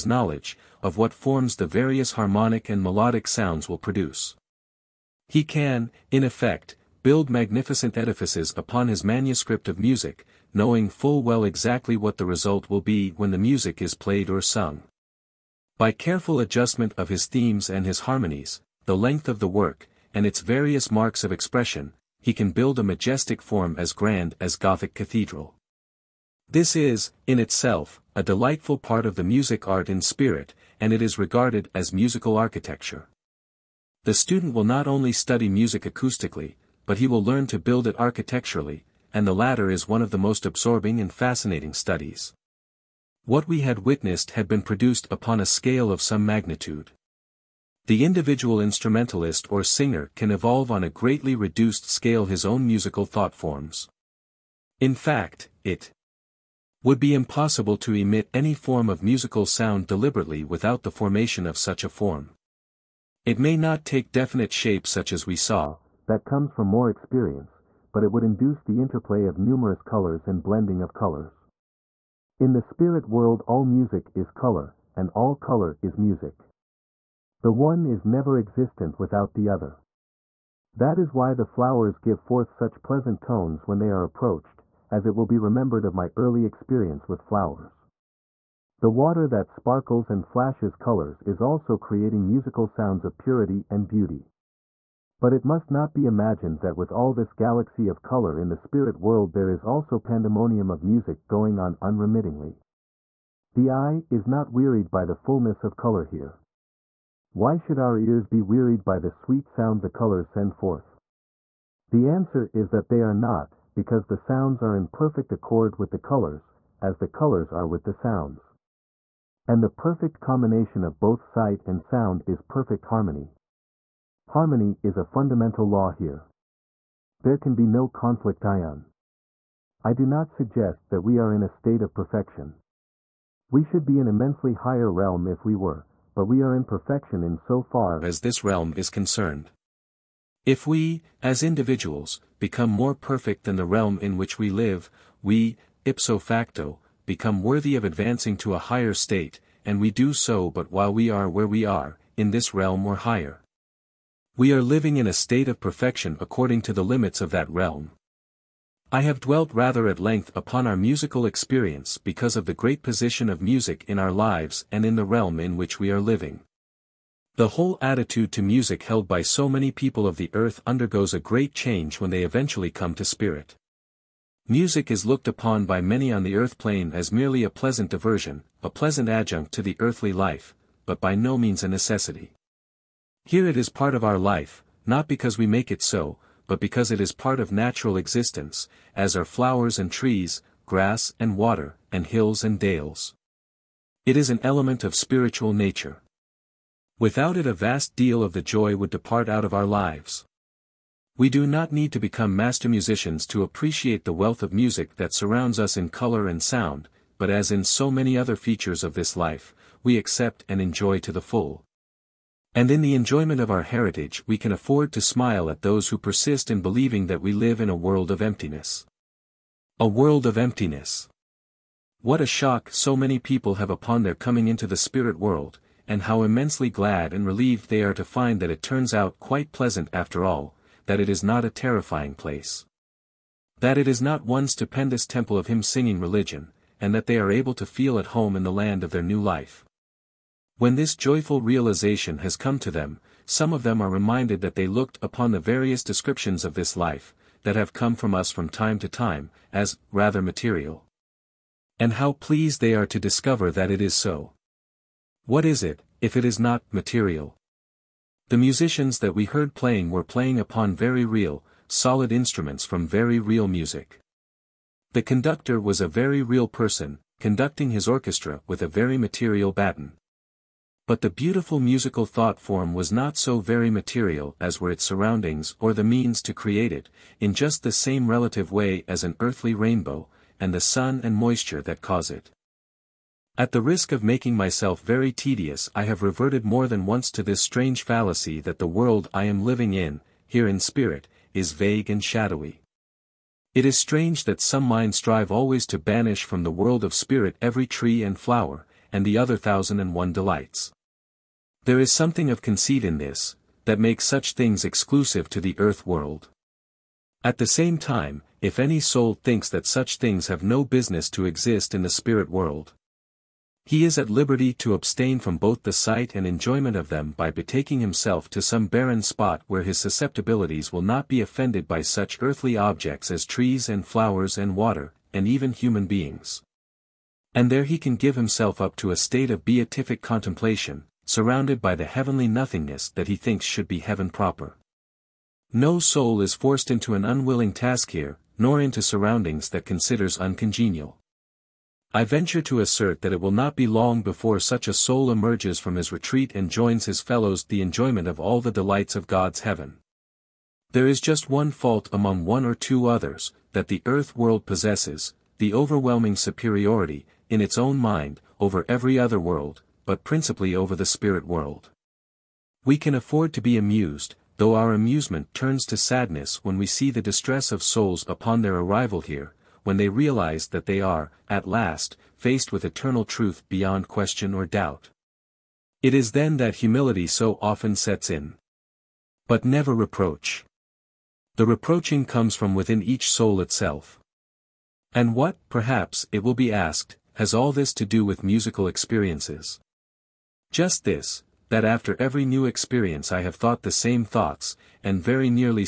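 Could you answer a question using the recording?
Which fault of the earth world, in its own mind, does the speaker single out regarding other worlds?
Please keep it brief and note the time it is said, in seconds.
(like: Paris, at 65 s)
overwhelming superiority, at 355 s.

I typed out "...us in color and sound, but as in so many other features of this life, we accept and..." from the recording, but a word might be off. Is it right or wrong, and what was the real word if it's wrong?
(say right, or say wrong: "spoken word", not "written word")
right.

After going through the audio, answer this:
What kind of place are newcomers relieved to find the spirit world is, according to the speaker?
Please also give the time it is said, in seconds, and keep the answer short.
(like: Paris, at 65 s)
a terrifying place, at 231 s.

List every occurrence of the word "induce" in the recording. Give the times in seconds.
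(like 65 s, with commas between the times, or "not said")
68 s.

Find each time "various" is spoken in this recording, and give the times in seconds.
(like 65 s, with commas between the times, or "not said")
1 s, 20 s, 245 s.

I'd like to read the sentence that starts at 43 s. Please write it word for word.
What we had witnessed had been produced upon a scale of some magnitude.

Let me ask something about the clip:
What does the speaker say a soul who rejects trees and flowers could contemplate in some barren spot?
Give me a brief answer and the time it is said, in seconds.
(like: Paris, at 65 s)
heavenly nothingness, at 331 s.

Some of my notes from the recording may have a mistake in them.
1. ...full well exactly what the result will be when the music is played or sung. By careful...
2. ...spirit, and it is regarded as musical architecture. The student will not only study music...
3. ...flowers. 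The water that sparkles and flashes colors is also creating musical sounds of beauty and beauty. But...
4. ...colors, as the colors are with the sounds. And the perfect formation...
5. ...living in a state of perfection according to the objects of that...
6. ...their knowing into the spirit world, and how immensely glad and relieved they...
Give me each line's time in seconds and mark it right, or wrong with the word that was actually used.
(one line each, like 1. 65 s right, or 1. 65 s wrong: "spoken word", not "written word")
1. 10 s right
2. 30 s right
3. 87 s wrong: "purity", not "beauty"
4. 115 s wrong: "combination", not "formation"
5. 154 s wrong: "limits", not "objects"
6. 224 s wrong: "coming", not "knowing".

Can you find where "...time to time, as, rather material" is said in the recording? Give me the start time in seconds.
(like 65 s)
248 s.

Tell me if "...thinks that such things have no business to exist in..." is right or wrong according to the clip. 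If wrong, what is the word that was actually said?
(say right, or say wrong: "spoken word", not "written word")
right.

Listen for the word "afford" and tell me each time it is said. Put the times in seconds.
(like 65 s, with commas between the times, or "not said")
214 s, 362 s.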